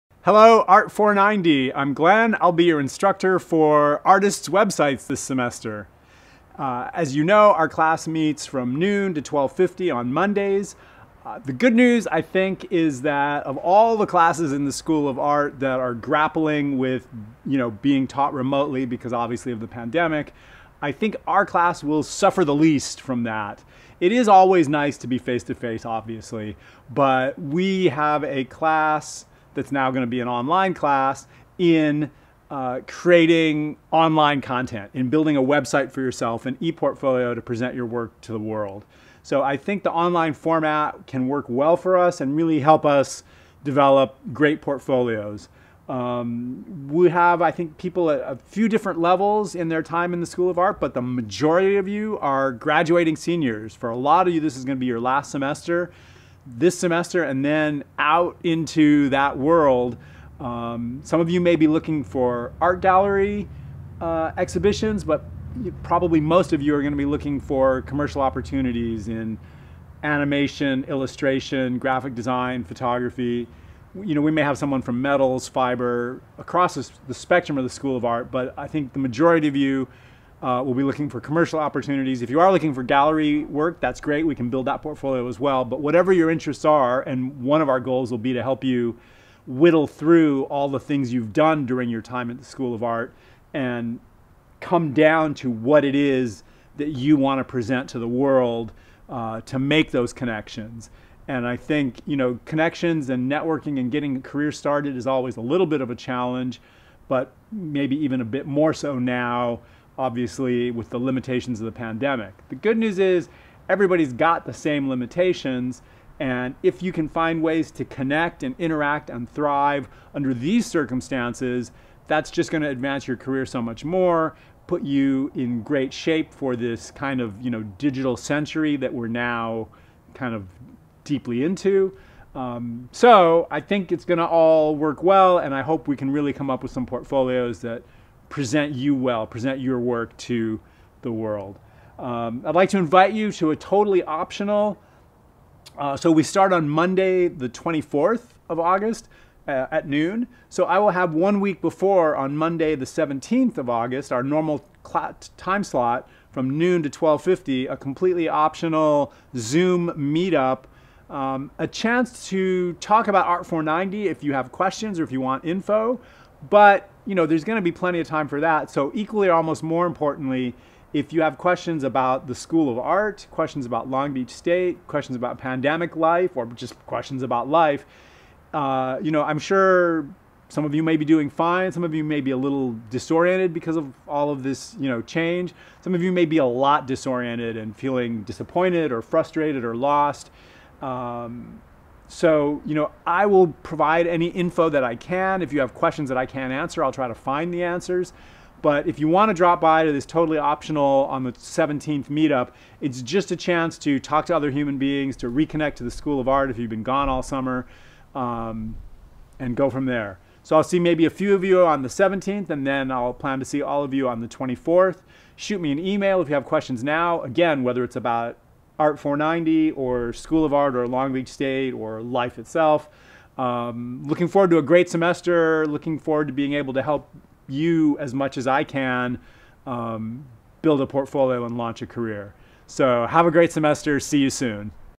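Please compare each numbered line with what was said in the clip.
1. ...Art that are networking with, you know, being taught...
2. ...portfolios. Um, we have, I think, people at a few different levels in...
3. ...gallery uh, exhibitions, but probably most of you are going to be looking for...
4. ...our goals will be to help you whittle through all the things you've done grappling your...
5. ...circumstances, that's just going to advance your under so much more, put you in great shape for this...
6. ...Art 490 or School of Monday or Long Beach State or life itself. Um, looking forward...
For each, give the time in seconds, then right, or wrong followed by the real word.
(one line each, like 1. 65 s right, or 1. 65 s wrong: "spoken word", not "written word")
1. 15 s wrong: "grappling", not "networking"
2. 44 s right
3. 62 s right
4. 87 s wrong: "during", not "grappling"
5. 120 s wrong: "career", not "under"
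6. 218 s wrong: "Art", not "Monday".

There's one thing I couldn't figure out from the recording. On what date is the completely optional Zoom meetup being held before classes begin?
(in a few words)
August 17.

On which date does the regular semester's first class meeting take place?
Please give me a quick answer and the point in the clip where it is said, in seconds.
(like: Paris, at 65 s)
August 24, at 147 s.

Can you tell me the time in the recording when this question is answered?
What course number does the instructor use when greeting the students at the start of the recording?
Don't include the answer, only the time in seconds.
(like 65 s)
0 s.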